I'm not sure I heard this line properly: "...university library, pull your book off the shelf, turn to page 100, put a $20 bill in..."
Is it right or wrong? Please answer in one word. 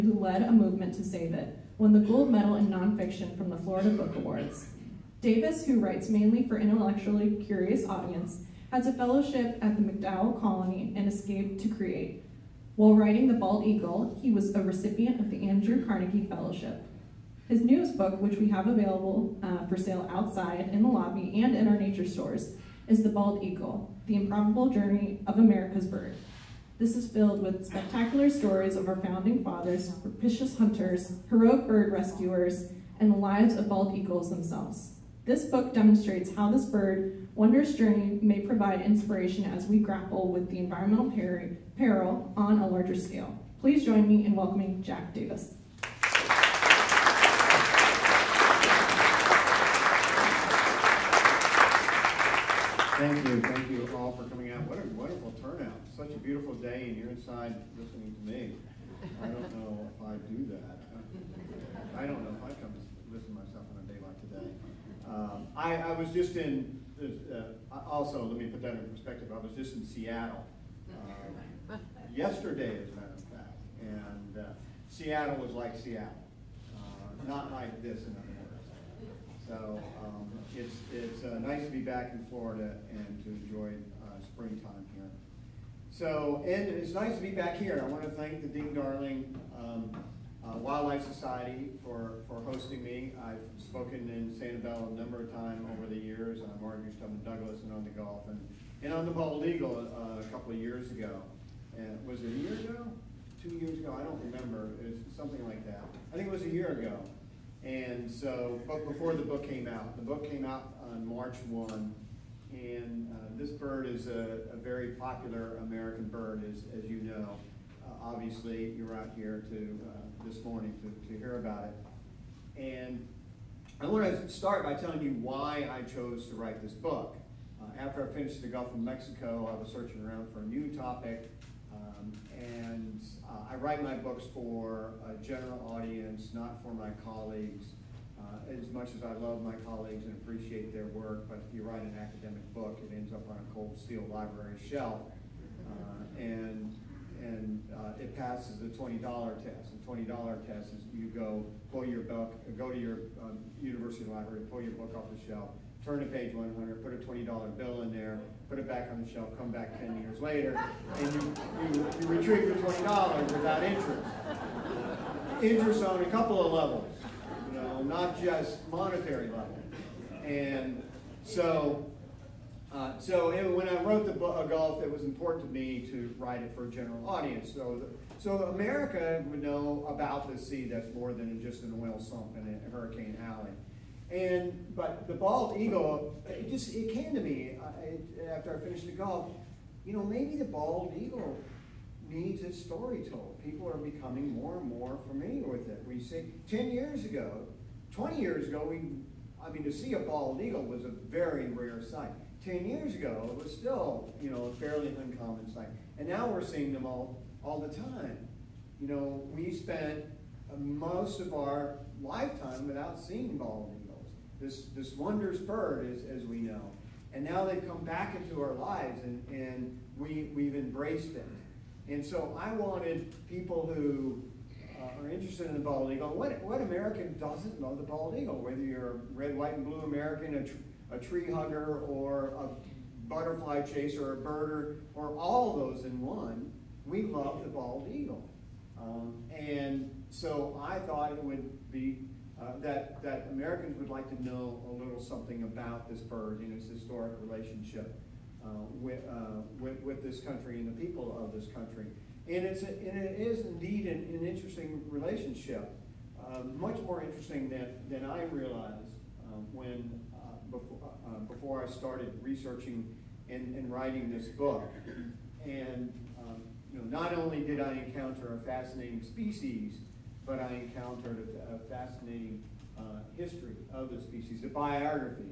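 right.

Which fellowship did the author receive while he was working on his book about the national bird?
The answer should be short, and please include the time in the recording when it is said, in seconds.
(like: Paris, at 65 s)
Andrew Carnegie Fellowship, at 15 s.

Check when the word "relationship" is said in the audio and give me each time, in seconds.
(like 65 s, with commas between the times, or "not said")
247 s, 254 s.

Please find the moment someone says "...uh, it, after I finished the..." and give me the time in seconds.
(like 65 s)
187 s.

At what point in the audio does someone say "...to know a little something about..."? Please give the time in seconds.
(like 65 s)
244 s.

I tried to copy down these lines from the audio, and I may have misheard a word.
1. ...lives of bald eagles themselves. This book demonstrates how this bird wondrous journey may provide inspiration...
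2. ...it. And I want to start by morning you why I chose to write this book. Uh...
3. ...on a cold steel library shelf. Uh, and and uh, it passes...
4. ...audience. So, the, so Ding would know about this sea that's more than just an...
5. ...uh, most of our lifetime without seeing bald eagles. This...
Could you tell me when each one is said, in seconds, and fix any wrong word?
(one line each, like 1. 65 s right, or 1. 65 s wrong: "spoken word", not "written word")
1. 33 s right
2. 121 s wrong: "telling", not "morning"
3. 143 s right
4. 177 s wrong: "America", not "Ding"
5. 210 s right.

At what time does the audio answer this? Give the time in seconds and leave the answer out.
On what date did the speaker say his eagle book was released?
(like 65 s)
111 s.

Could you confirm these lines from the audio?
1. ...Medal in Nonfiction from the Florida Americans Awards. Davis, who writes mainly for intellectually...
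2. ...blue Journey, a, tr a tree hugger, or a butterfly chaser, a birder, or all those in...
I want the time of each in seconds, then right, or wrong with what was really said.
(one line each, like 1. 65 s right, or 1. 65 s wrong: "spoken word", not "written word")
1. 2 s wrong: "Book", not "Americans"
2. 229 s wrong: "American", not "Journey".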